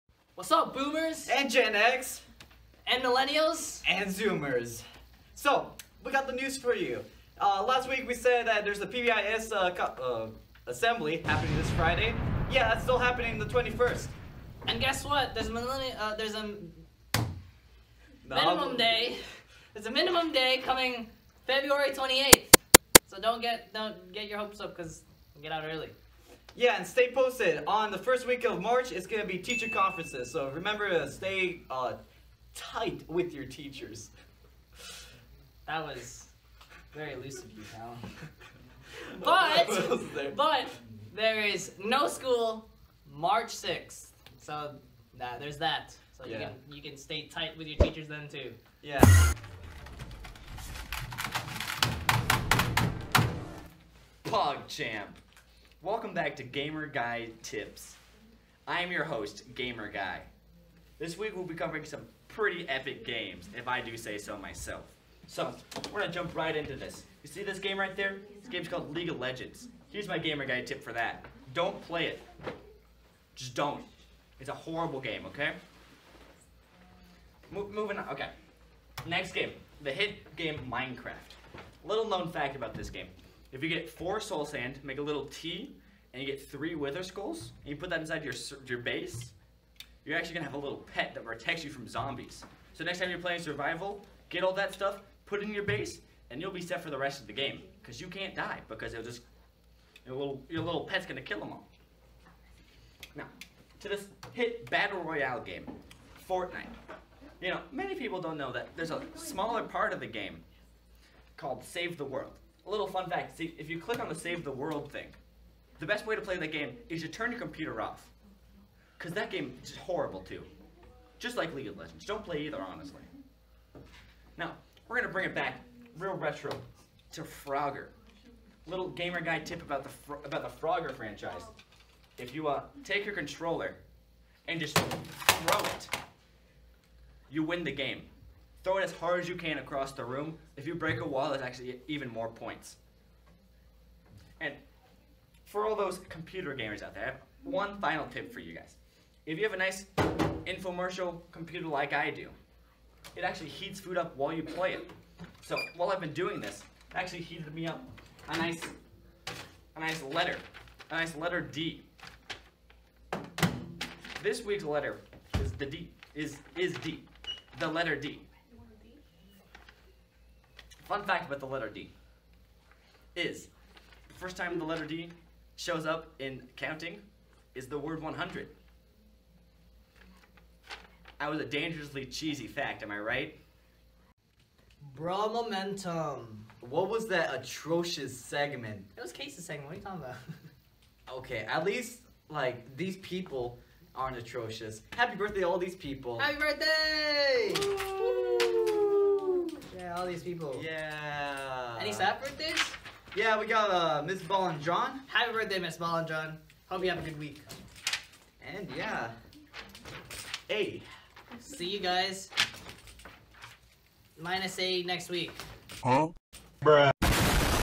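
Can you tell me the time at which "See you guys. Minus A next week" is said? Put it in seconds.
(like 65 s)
211 s.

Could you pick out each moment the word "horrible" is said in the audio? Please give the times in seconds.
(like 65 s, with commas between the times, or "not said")
74 s, 119 s.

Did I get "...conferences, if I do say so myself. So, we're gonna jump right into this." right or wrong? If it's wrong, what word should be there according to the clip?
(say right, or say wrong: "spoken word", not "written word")
wrong: "games", not "conferences".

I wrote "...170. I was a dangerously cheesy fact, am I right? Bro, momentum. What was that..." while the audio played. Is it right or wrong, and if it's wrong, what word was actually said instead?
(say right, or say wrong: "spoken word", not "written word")
wrong: "100", not "170".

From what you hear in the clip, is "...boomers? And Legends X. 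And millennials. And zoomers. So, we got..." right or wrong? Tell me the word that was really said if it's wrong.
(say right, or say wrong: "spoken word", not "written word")
wrong: "Gen", not "Legends".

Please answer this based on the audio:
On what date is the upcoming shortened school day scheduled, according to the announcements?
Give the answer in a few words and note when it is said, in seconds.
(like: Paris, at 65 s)
February 28th, at 21 s.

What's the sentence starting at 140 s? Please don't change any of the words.
If you break a wall, it's actually even more points.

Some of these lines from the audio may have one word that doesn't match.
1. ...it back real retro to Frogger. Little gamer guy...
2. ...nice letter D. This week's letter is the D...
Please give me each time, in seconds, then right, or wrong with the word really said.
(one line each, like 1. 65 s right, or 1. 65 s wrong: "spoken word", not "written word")
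1. 125 s right
2. 160 s right.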